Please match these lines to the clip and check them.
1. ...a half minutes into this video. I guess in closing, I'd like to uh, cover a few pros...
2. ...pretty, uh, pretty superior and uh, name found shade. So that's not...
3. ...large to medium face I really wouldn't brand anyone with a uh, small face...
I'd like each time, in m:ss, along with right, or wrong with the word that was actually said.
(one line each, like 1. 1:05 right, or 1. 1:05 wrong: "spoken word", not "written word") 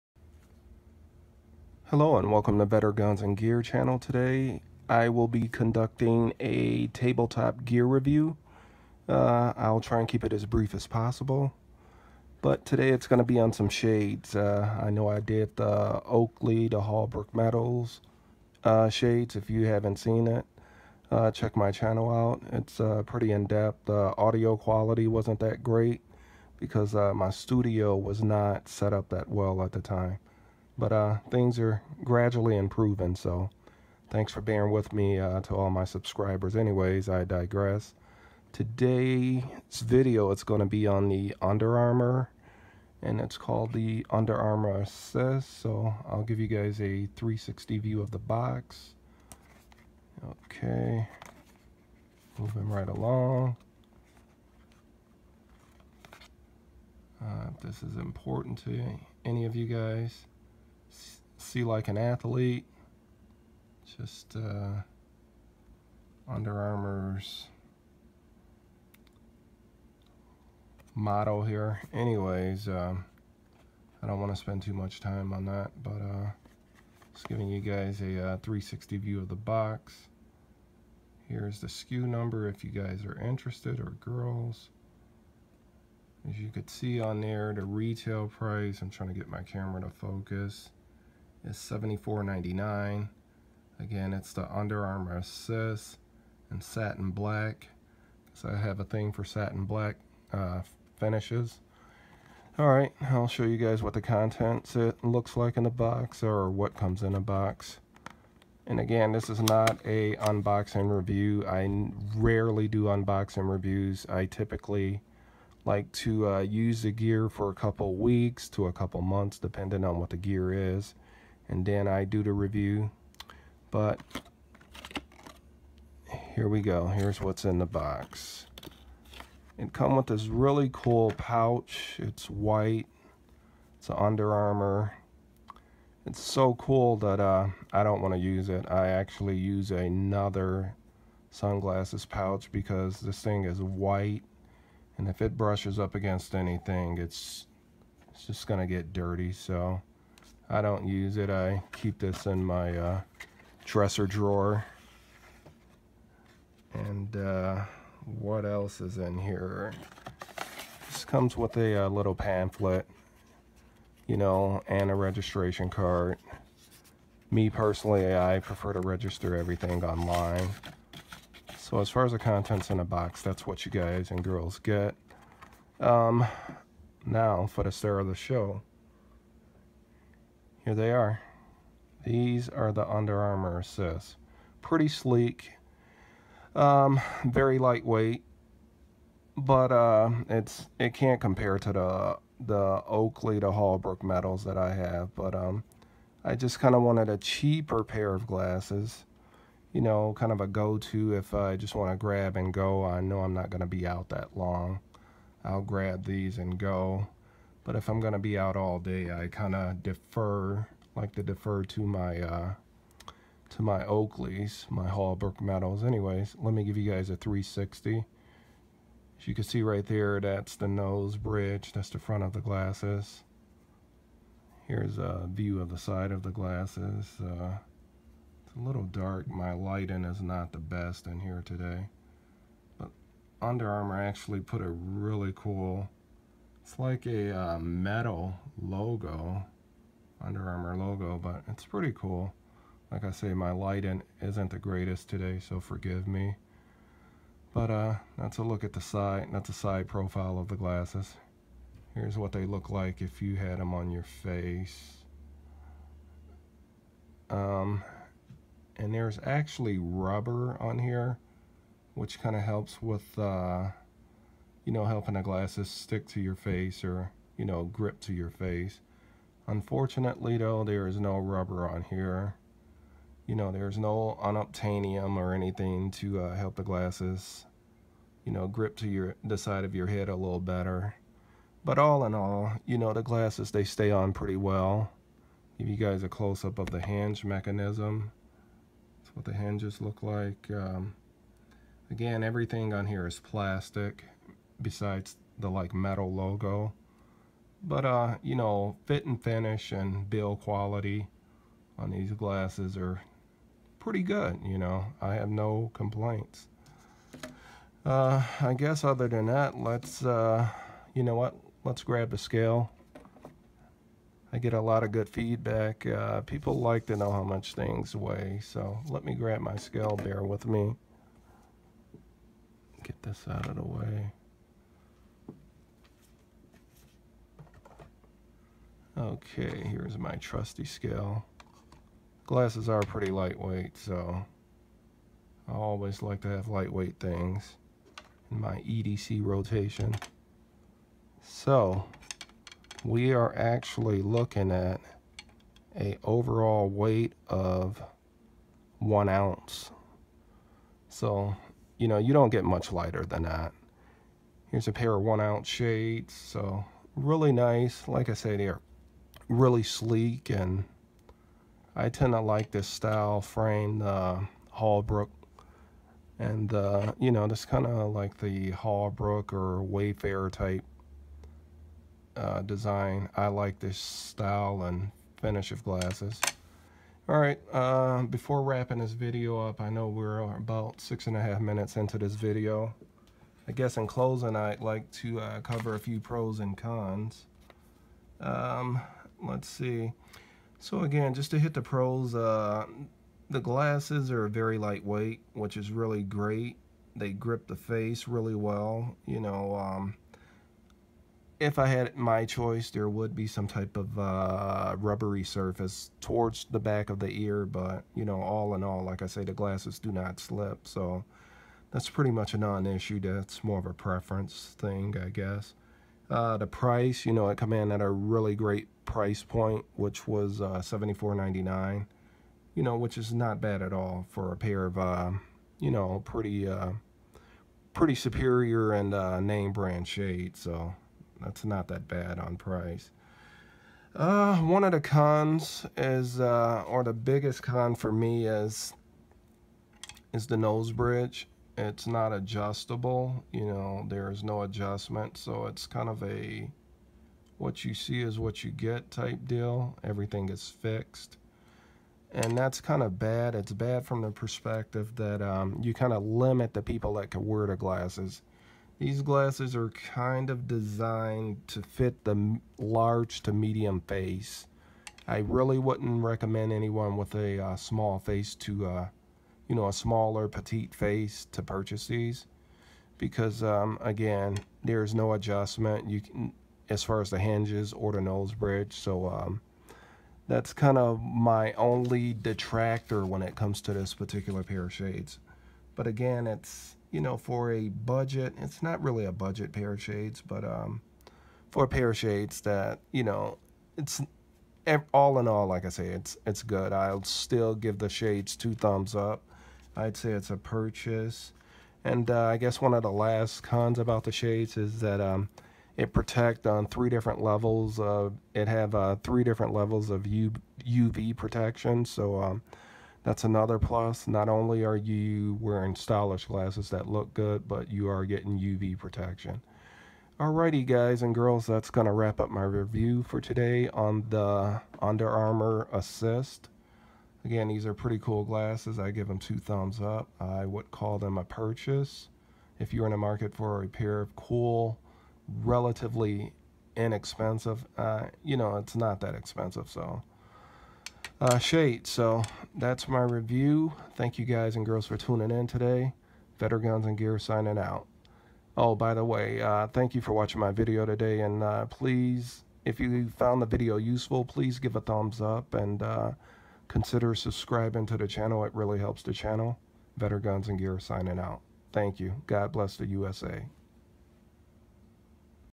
1. 6:21 right
2. 7:06 wrong: "brand", not "found"
3. 7:42 wrong: "recommend", not "brand".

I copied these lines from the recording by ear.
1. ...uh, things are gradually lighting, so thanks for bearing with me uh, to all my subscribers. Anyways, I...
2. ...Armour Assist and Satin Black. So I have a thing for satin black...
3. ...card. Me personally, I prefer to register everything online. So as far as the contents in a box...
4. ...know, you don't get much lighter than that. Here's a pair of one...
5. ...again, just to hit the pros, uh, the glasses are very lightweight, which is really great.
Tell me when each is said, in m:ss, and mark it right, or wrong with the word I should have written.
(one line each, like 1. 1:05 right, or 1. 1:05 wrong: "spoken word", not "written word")
1. 0:30 wrong: "improving", not "lighting"
2. 1:34 right
3. 2:45 right
4. 5:51 right
5. 6:30 right.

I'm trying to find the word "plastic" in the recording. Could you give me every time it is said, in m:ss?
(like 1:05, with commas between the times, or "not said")
4:53.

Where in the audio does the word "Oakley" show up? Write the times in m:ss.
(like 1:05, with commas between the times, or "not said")
0:16, 3:12, 3:33.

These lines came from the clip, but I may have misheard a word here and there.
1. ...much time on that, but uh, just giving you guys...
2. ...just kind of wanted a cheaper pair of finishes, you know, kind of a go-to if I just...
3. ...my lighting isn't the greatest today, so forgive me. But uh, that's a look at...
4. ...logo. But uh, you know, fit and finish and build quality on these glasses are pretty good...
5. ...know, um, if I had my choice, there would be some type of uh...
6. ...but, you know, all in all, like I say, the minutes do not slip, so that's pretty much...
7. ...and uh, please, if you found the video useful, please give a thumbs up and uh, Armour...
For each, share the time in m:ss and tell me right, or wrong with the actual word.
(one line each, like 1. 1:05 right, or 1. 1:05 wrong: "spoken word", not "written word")
1. 1:14 right
2. 3:16 wrong: "glasses", not "finishes"
3. 4:03 right
4. 4:56 right
5. 6:39 right
6. 6:47 wrong: "glasses", not "minutes"
7. 9:11 wrong: "Consider", not "Armour".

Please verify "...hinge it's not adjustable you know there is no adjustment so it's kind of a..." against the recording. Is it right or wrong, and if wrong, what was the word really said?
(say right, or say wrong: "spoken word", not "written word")
wrong: "bridge", not "hinge".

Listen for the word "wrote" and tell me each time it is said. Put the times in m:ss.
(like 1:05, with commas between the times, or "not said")
not said.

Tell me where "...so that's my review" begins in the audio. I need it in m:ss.
9:01.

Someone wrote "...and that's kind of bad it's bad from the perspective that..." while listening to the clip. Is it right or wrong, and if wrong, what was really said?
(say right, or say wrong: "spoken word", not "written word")
right.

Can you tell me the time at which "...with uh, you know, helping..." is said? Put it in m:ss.
4:22.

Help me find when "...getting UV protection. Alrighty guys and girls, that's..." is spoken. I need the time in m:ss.
8:38.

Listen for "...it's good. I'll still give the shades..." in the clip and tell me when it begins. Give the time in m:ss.
8:16.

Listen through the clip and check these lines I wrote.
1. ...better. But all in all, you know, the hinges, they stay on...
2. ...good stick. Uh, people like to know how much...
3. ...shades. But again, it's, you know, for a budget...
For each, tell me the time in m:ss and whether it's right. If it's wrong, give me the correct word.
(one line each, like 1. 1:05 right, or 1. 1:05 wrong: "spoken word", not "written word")
1. 4:40 wrong: "glasses", not "hinges"
2. 5:14 wrong: "feedback", not "stick"
3. 8:04 right.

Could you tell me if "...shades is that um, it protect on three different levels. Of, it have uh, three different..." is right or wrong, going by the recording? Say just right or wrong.
right.